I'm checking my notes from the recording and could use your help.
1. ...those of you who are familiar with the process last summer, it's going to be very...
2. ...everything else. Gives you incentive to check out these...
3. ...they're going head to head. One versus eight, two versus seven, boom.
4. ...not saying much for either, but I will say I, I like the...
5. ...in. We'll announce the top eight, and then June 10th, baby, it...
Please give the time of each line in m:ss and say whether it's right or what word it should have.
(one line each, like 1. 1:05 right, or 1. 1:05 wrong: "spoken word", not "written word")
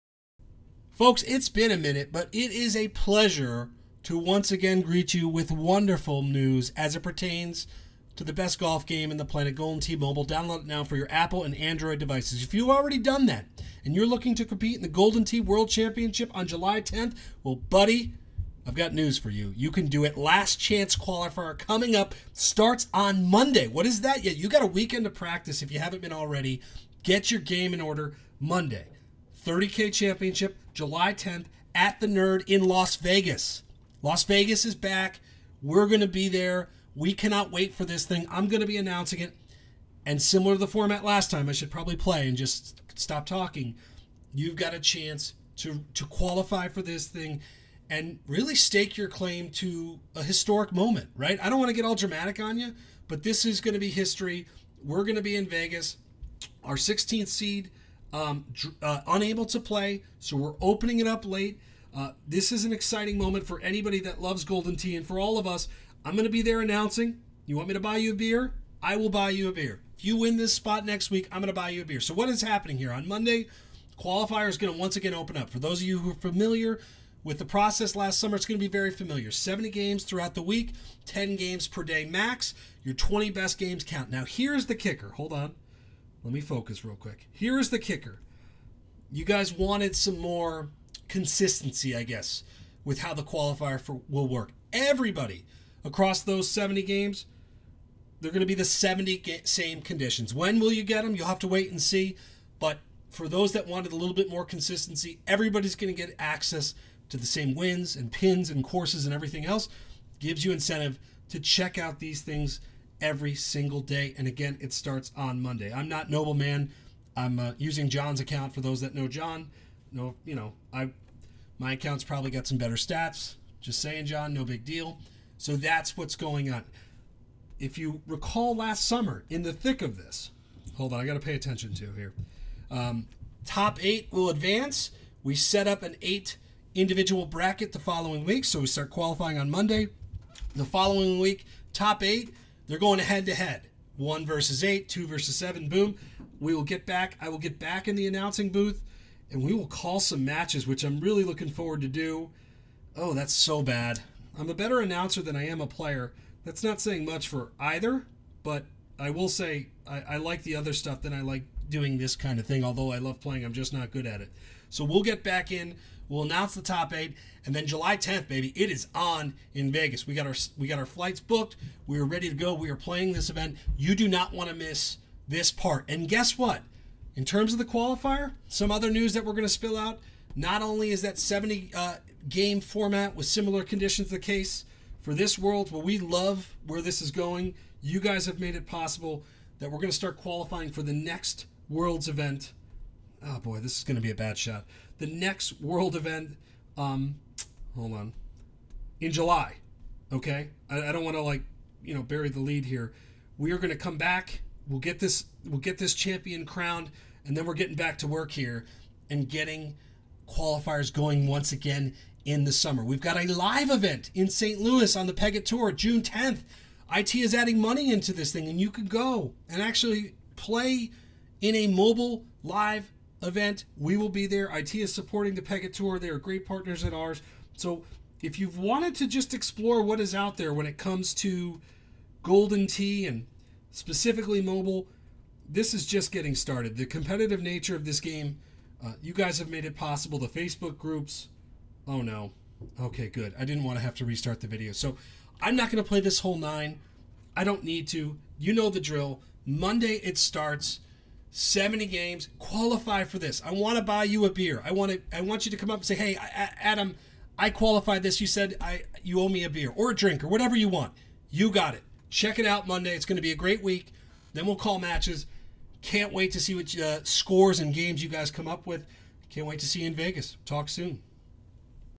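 1. 1:15 right
2. 1:49 right
3. 2:22 right
4. 2:36 right
5. 2:45 wrong: "July", not "June".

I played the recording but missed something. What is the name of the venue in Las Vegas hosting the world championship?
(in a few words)
The Nerd.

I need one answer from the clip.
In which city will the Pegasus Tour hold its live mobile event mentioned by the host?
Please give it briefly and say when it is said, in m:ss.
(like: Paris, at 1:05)
St. Louis, at 3:34.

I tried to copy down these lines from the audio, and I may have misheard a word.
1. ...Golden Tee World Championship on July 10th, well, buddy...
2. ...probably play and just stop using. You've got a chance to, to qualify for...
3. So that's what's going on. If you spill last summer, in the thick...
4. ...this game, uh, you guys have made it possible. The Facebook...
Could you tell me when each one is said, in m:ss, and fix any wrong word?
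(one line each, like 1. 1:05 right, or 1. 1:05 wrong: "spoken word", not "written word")
1. 0:14 right
2. 0:41 wrong: "talking", not "using"
3. 2:05 wrong: "recall", not "spill"
4. 3:57 right.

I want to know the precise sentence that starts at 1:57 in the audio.
I'm uh, using John's account for those that know John.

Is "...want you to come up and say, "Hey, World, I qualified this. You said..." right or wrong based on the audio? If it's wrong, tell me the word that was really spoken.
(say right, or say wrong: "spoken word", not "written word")
wrong: "Adam", not "World".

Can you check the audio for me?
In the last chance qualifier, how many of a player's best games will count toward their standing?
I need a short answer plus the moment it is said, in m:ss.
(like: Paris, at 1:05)
20, at 1:22.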